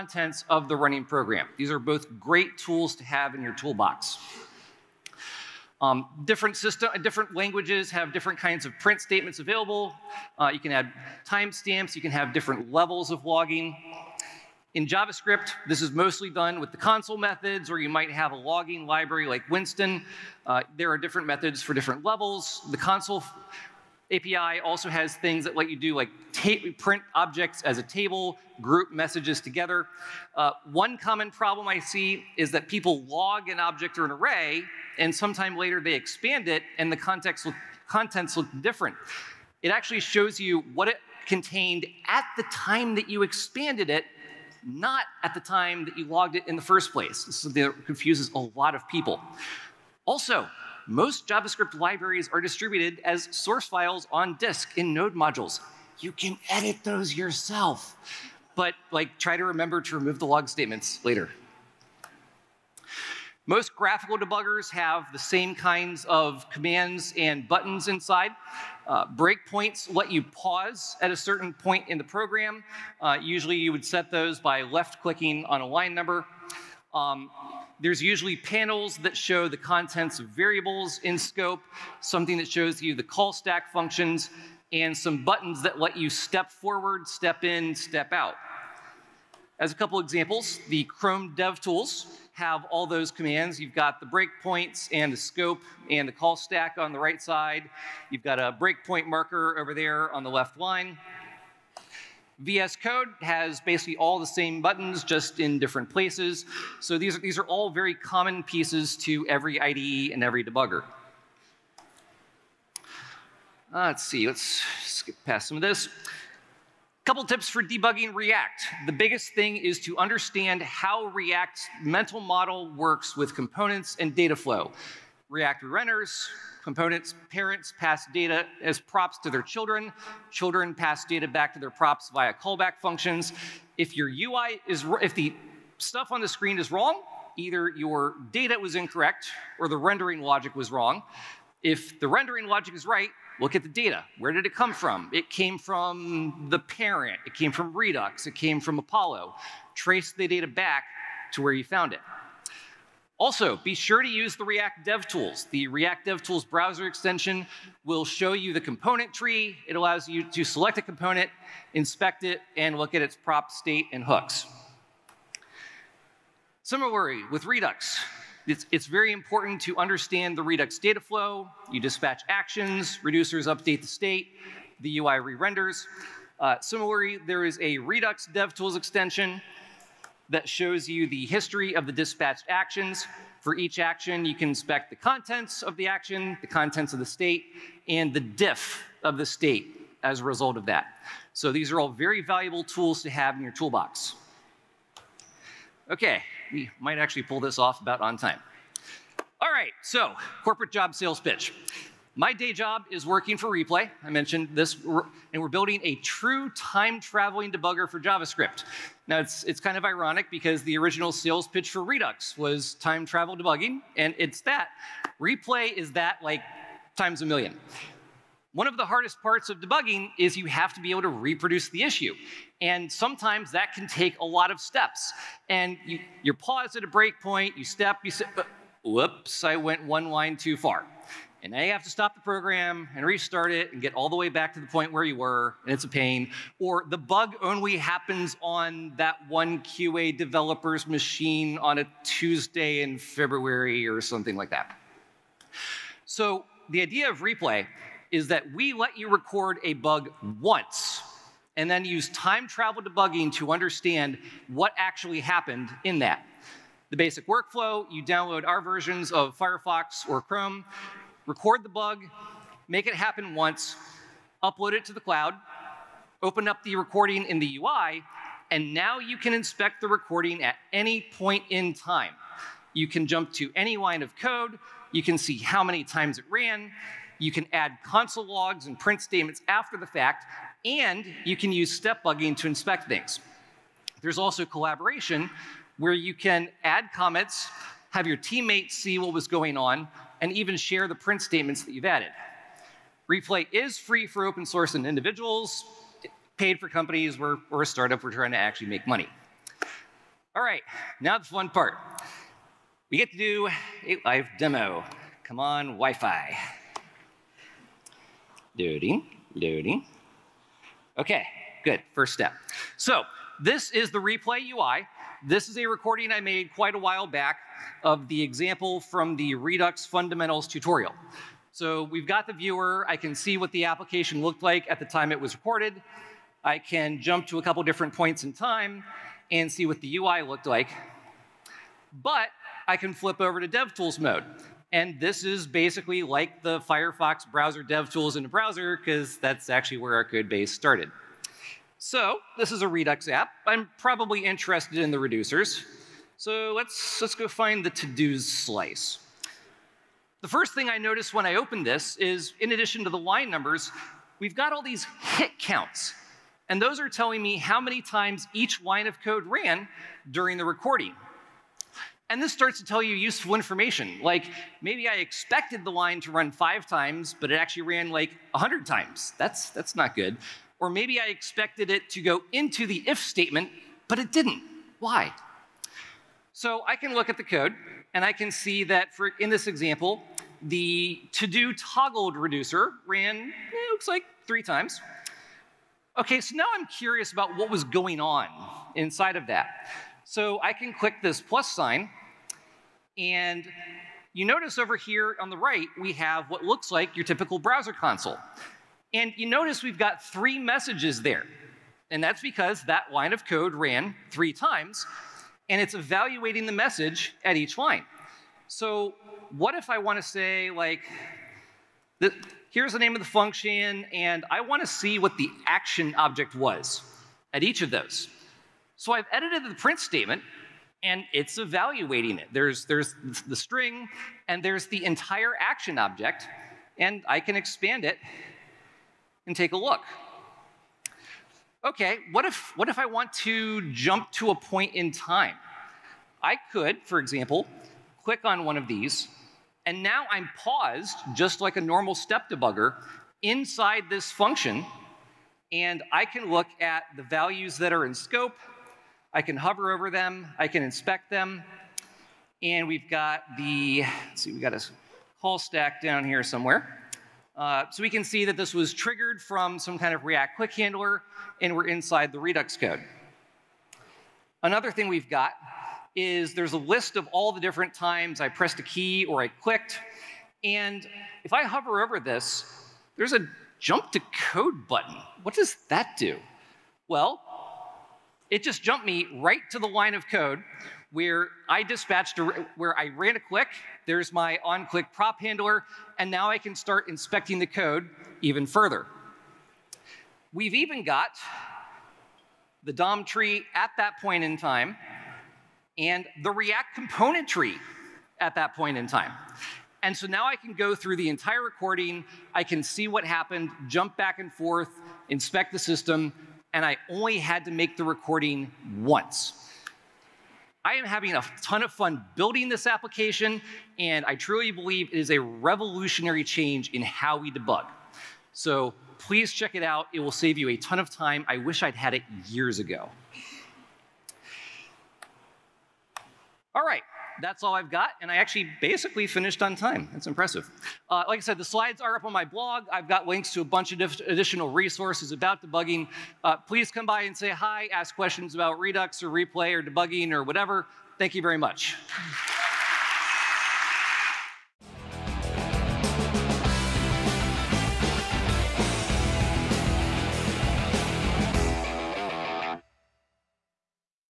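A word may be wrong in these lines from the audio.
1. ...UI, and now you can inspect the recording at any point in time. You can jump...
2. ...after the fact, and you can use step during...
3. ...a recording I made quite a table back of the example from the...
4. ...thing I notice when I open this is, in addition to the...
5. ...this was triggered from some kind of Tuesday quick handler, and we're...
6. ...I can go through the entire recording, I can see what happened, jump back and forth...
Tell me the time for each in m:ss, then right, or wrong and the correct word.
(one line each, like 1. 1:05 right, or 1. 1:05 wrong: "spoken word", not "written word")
1. 4:27 right
2. 4:39 wrong: "bugging", not "during"
3. 5:15 wrong: "while", not "table"
4. 5:50 right
5. 7:38 wrong: "React", not "Tuesday"
6. 8:20 right.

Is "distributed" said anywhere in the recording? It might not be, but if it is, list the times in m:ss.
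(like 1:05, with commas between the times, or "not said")
0:52.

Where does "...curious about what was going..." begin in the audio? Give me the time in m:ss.
6:26.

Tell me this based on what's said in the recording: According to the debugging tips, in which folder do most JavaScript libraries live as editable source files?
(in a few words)
node modules.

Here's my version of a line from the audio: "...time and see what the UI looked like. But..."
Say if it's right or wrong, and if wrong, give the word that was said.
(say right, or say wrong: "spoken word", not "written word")
right.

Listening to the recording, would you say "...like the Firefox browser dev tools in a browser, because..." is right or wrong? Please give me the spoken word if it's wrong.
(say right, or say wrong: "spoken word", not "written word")
right.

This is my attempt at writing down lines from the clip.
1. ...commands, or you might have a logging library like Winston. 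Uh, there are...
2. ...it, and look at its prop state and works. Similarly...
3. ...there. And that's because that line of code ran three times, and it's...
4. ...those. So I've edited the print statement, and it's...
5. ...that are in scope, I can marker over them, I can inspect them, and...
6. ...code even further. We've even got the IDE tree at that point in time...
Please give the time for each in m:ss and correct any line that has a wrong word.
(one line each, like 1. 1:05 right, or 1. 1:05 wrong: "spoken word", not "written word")
1. 0:17 wrong: "methods", not "commands"
2. 2:42 wrong: "hooks", not "works"
3. 6:41 right
4. 6:57 right
5. 7:27 wrong: "hover", not "marker"
6. 8:07 wrong: "DOM", not "IDE".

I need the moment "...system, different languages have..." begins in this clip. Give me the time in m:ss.
0:06.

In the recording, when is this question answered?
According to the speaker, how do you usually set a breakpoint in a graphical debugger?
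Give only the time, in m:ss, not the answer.
1:14.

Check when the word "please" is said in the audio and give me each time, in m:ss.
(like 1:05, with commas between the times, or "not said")
8:38, 8:56.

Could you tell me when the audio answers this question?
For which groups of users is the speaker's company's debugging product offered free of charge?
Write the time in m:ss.
4:54.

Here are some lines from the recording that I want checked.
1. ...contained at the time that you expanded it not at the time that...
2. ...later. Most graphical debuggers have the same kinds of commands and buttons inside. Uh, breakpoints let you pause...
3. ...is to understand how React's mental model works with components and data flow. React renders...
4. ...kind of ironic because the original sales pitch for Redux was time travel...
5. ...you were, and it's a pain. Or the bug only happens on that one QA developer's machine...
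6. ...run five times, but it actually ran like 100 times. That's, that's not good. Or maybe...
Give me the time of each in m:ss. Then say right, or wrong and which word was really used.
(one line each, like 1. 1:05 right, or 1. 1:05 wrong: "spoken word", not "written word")
1. 0:41 right
2. 1:01 right
3. 1:59 right
4. 3:29 right
5. 3:55 right
6. 6:06 right.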